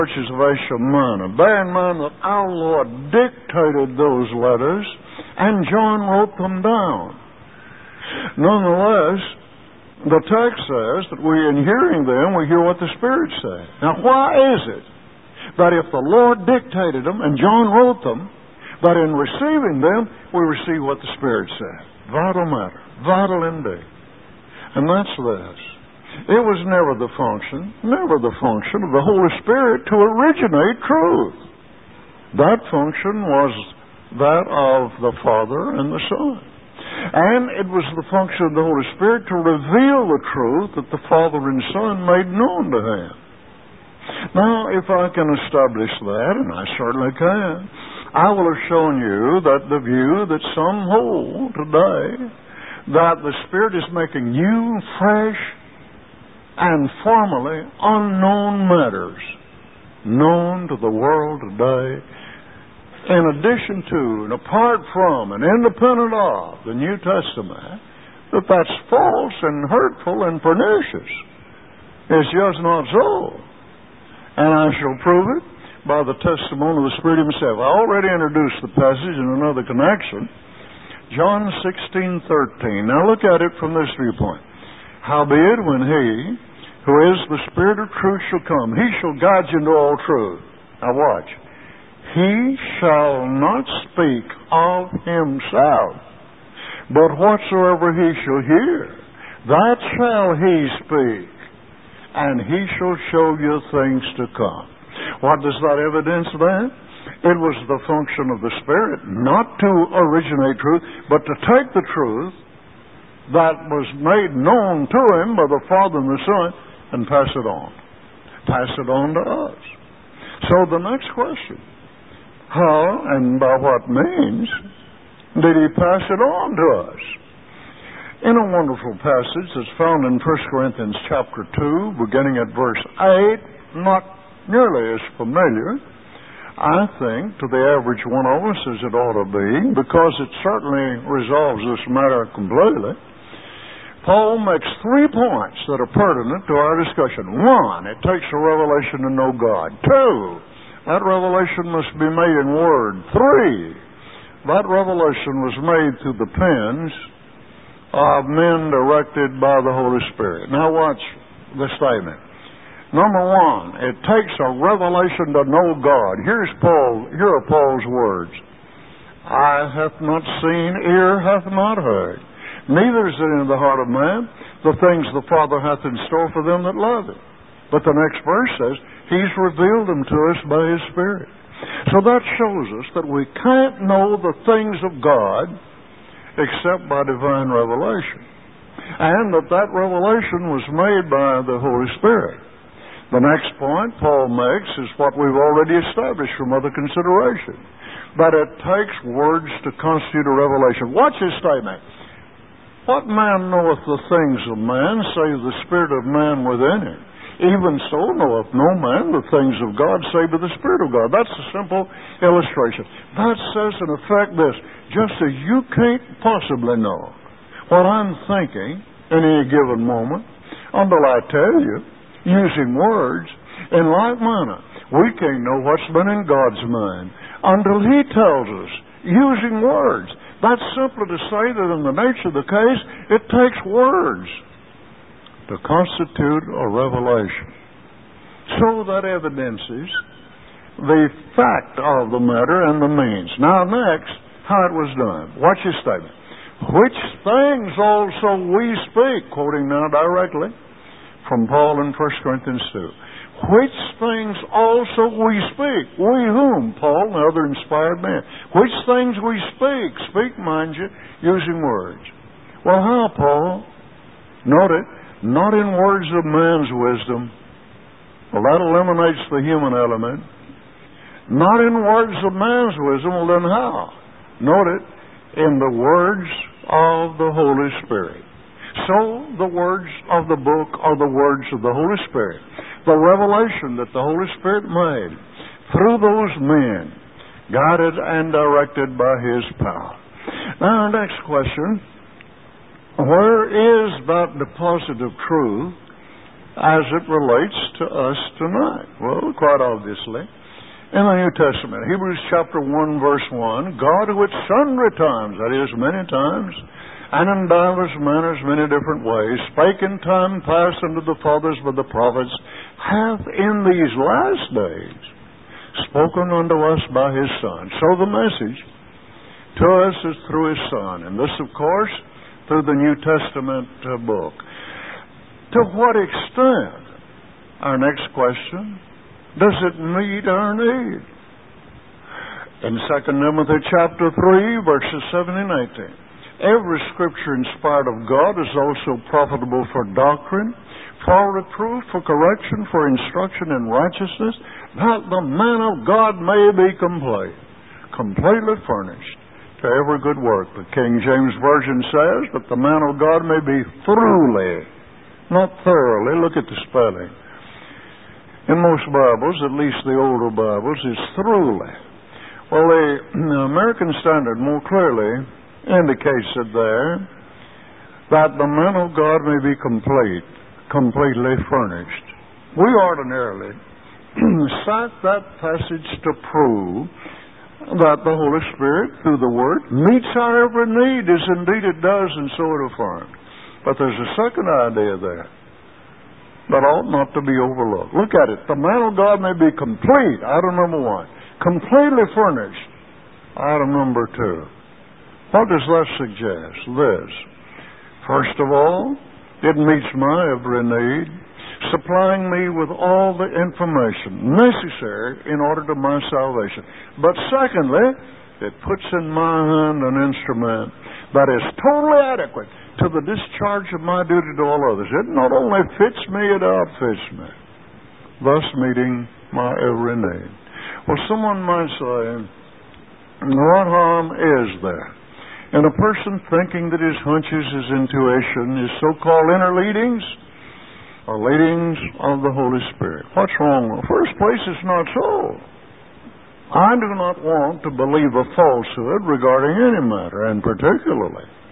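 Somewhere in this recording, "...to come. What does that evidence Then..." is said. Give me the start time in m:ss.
1:44.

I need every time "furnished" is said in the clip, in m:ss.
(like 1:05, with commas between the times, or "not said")
5:48, 6:11, 6:32.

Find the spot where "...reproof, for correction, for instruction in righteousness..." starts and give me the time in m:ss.
5:41.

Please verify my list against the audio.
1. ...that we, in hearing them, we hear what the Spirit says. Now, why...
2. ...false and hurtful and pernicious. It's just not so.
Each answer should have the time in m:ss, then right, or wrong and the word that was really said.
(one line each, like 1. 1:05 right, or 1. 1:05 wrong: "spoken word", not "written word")
1. 0:11 right
2. 1:08 right.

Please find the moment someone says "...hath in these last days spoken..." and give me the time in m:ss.
5:12.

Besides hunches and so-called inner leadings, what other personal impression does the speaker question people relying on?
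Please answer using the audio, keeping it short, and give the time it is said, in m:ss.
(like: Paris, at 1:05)
intuition, at 7:07.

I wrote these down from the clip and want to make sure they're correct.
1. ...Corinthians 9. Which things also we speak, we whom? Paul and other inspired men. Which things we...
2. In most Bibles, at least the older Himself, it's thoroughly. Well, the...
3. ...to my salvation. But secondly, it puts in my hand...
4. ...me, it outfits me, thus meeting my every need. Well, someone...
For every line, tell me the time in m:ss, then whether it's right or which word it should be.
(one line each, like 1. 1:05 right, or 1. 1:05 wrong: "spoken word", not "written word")
1. 4:12 wrong: "2", not "9"
2. 5:58 wrong: "Bibles", not "Himself"
3. 6:45 right
4. 6:56 right.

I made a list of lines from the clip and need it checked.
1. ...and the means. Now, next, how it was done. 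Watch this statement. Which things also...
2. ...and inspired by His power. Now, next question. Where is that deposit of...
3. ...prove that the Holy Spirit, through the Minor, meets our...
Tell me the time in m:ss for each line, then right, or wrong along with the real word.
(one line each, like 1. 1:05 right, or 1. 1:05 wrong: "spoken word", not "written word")
1. 4:02 right
2. 4:47 wrong: "directed", not "inspired"
3. 6:16 wrong: "Word", not "Minor".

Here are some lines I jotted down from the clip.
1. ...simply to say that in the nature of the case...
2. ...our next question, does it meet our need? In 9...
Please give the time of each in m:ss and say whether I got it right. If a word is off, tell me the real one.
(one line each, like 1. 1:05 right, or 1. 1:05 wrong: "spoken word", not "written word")
1. 3:50 right
2. 5:27 wrong: "2", not "9".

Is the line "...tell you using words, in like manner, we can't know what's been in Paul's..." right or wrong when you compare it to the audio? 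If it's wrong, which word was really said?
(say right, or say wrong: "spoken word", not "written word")
wrong: "God", not "Paul".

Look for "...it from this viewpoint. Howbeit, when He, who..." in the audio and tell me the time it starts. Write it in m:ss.
1:23.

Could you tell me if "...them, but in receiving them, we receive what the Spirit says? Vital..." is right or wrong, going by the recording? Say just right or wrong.
right.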